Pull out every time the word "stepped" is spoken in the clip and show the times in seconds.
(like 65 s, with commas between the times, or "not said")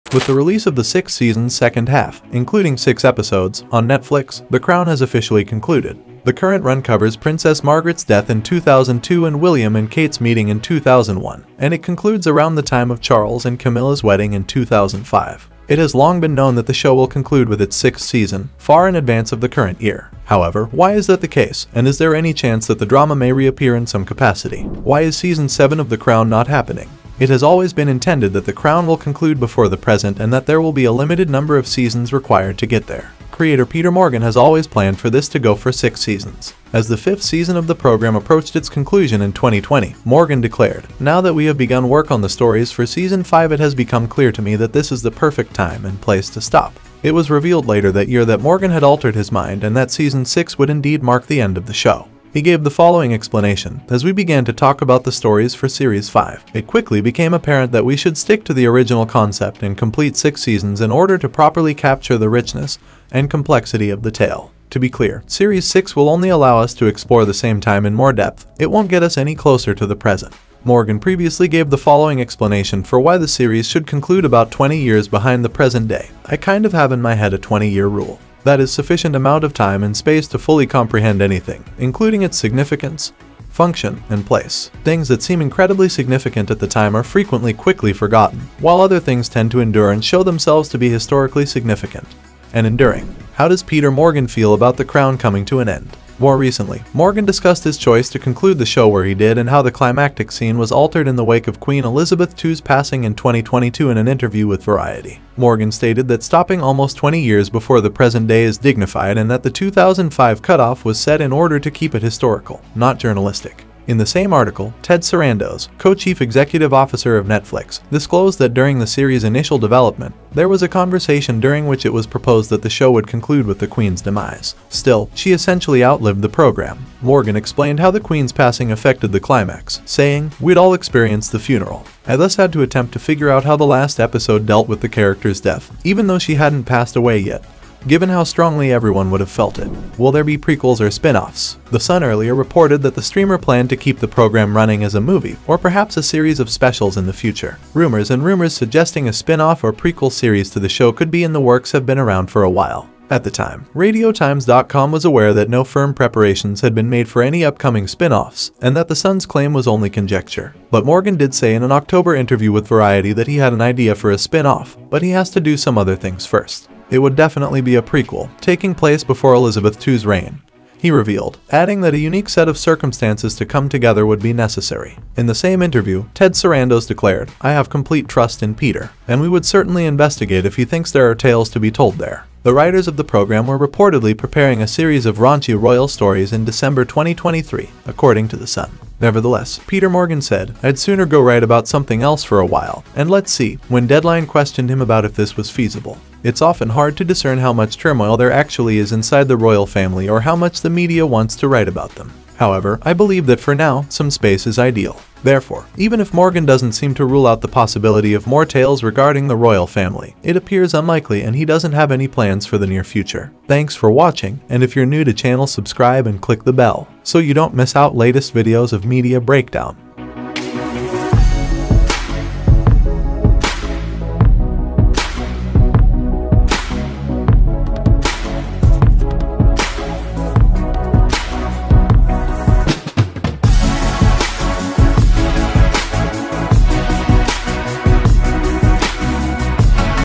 not said.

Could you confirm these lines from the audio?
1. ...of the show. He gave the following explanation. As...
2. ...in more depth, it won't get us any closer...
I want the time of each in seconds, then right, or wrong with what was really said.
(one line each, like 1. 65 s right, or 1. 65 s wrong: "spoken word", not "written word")
1. 51 s right
2. 67 s right.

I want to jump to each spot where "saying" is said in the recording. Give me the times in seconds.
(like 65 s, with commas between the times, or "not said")
129 s.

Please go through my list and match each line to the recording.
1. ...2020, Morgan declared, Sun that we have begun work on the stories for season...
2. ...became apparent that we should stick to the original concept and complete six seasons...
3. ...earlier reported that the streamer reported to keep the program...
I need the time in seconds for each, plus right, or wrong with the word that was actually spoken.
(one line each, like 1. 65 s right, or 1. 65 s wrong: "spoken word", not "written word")
1. 39 s wrong: "Now", not "Sun"
2. 57 s right
3. 142 s wrong: "planned", not "reported".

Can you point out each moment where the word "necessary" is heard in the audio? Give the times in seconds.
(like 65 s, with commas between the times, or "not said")
174 s.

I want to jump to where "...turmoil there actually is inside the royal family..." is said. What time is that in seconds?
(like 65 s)
197 s.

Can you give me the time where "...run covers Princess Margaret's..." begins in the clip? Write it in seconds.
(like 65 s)
6 s.